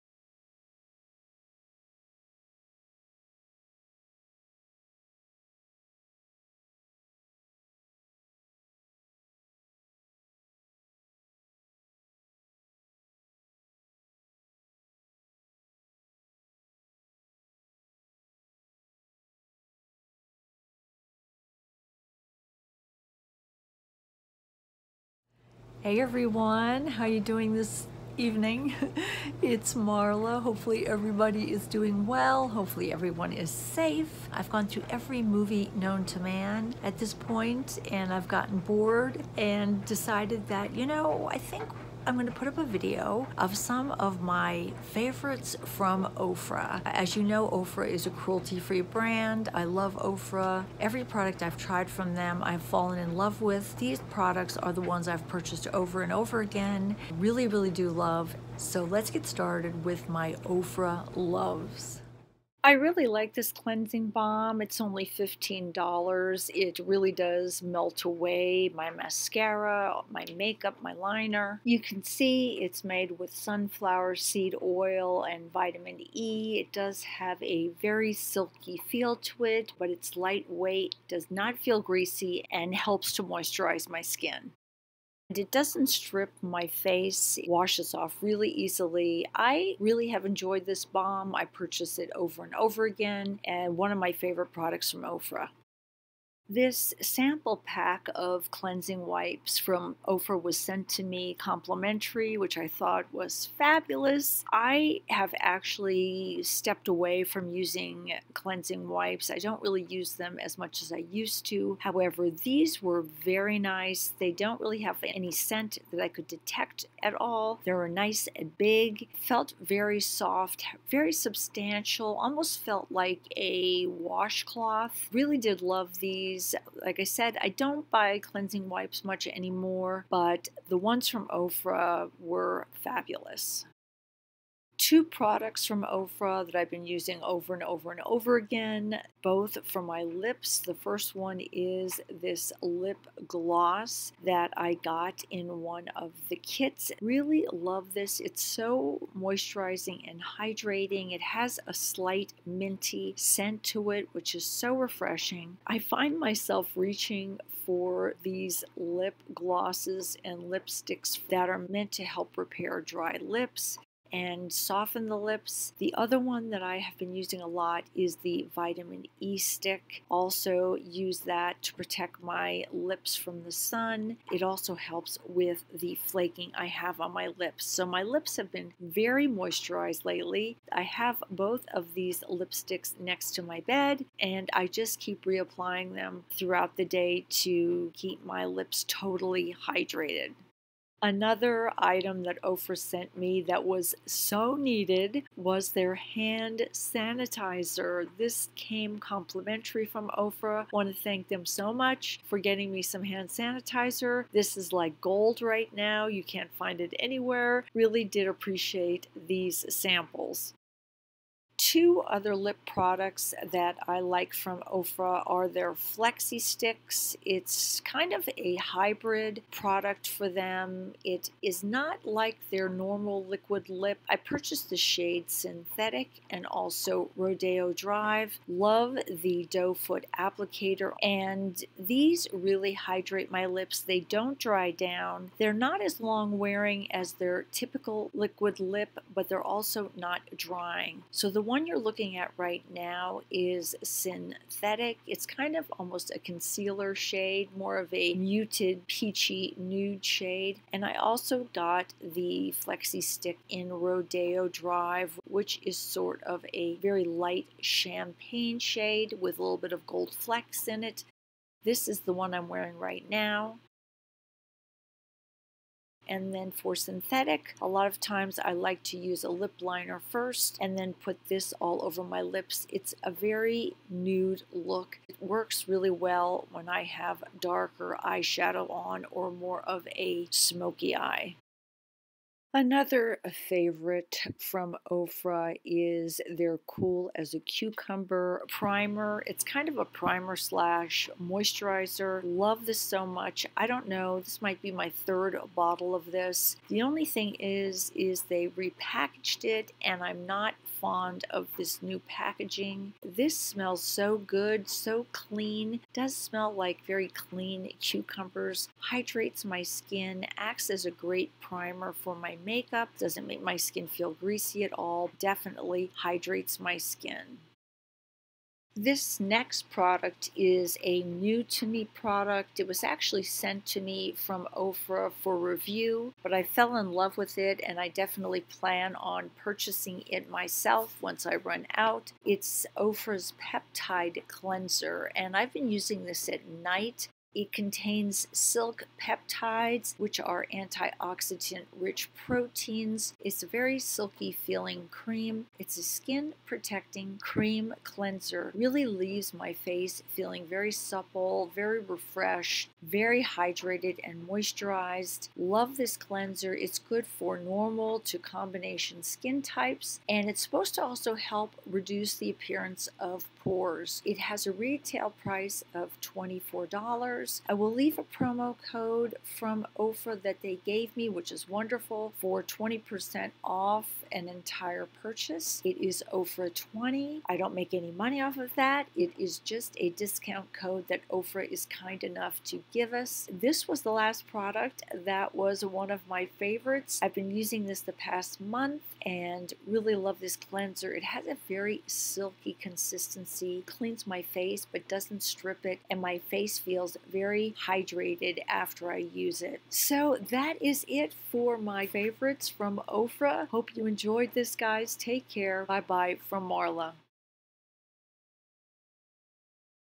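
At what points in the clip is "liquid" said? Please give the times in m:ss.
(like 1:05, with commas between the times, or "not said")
3:43, 3:58.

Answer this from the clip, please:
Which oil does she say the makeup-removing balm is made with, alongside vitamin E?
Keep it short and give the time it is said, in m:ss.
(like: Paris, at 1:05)
sunflower seed oil, at 1:13.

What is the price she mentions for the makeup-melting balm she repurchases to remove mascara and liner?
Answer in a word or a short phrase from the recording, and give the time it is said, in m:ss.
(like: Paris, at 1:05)
$15, at 1:05.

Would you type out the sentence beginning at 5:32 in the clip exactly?
It's Ofra's Peptide Cleanser, and I've been using this at night it contains silk peptides, which are antioxidant rich proteins.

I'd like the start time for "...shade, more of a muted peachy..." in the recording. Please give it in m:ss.
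4:06.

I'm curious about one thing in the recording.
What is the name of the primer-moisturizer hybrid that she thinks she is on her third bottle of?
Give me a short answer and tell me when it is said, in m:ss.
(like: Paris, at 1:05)
Cool as a Cucumber, at 4:46.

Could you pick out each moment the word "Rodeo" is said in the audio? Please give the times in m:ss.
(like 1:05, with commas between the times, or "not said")
3:47, 4:13.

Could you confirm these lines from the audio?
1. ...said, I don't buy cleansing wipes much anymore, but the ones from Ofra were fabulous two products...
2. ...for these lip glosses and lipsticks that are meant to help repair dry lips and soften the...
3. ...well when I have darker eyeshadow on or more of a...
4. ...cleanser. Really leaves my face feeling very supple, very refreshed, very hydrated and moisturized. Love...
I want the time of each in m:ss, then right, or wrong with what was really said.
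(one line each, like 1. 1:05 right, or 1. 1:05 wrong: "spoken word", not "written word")
1. 2:07 right
2. 2:37 right
3. 4:35 right
4. 5:47 right.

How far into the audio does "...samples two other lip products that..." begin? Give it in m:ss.
3:29.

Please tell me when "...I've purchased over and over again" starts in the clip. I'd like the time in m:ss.
0:55.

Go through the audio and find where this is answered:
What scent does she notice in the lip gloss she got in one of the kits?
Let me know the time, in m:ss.
2:32.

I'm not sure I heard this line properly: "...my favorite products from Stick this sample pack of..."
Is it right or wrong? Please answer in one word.
wrong.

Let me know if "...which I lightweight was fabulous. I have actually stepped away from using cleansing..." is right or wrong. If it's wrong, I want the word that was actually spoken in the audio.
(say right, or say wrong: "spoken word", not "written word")
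wrong: "thought", not "lightweight".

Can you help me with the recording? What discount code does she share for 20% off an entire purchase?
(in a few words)
Ofra 20.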